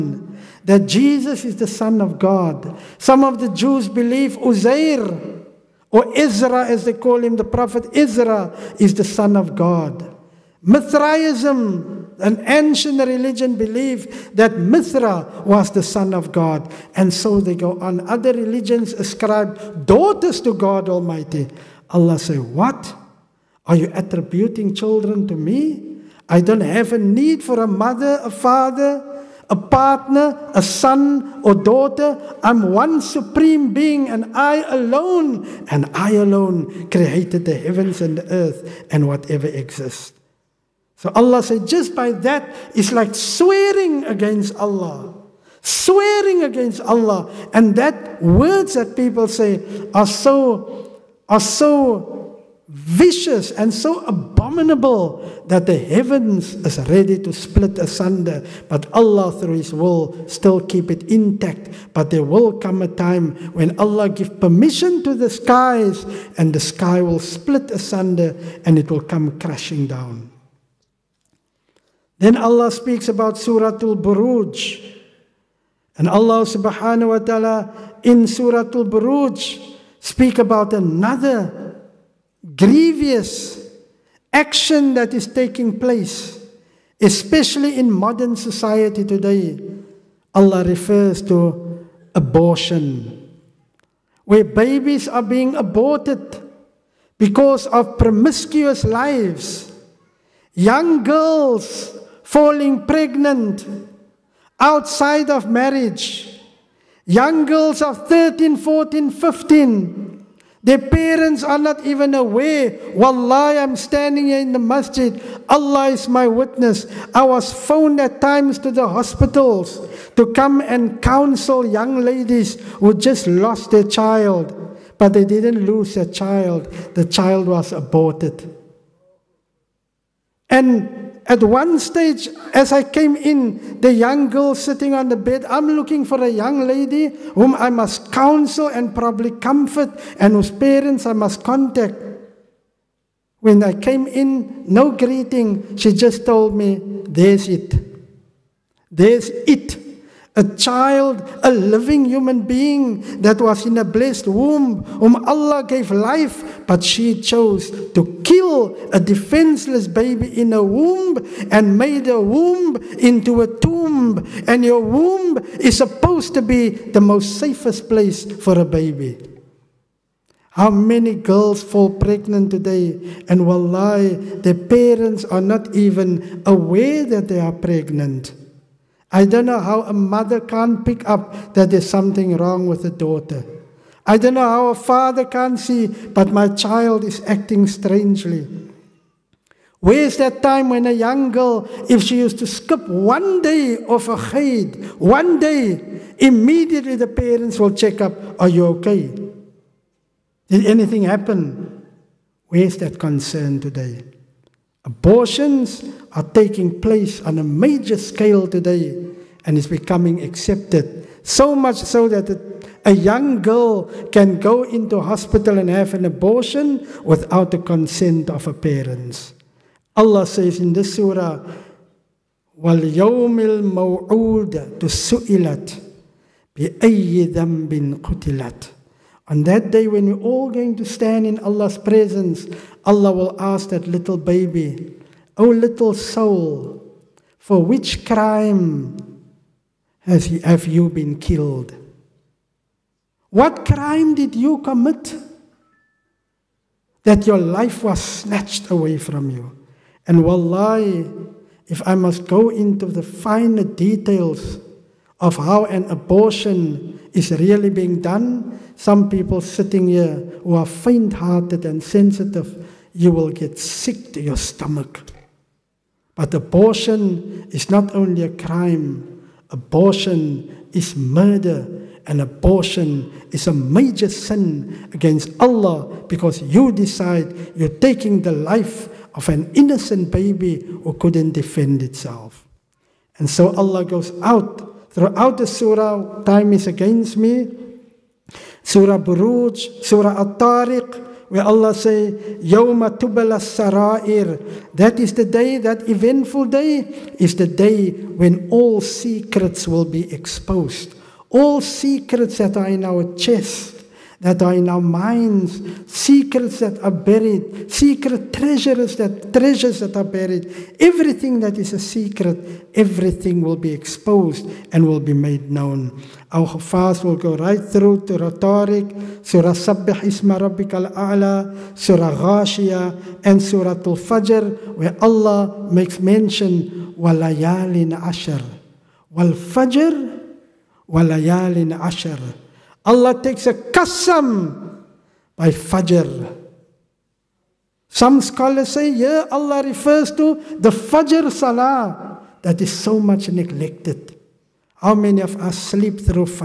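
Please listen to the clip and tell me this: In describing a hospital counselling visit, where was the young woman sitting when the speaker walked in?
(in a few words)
On the bed.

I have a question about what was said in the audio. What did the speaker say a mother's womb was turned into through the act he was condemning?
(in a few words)
A tomb.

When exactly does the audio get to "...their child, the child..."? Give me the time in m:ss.
2:05.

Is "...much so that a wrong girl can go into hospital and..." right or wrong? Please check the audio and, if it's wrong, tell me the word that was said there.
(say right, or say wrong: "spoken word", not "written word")
wrong: "young", not "wrong".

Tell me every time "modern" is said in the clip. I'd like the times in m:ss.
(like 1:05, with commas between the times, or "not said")
1:27.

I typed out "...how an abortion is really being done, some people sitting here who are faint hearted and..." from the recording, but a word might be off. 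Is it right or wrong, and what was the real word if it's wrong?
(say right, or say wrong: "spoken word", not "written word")
right.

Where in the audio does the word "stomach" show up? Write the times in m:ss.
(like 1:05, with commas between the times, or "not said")
4:24.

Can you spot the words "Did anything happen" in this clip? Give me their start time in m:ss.
3:20.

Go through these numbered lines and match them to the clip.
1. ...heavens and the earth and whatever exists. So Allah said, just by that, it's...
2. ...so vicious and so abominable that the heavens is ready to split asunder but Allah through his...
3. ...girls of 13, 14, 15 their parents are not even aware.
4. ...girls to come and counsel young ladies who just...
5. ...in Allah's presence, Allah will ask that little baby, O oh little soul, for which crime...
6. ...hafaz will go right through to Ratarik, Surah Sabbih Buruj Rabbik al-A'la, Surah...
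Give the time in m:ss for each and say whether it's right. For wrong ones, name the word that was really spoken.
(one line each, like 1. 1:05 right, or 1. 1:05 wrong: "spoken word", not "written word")
1. 0:37 right
2. 0:51 right
3. 1:47 right
4. 1:58 wrong: "hospitals", not "girls"
5. 3:51 right
6. 5:16 wrong: "Isma", not "Buruj".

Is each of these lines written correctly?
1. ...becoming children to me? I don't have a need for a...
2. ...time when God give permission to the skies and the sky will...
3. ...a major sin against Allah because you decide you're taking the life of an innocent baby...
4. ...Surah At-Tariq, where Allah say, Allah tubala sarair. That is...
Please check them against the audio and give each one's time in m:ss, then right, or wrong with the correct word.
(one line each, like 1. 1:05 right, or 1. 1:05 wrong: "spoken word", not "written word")
1. 0:23 wrong: "attributing", not "becoming"
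2. 1:02 wrong: "Allah", not "God"
3. 4:33 right
4. 4:49 wrong: "Yawma", not "Allah".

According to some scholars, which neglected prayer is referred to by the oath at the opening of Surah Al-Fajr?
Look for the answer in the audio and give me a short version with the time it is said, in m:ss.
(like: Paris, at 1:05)
Fajr Salah, at 5:40.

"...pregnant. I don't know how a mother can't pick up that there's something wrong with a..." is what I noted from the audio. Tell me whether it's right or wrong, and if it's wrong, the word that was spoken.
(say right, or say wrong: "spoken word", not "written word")
right.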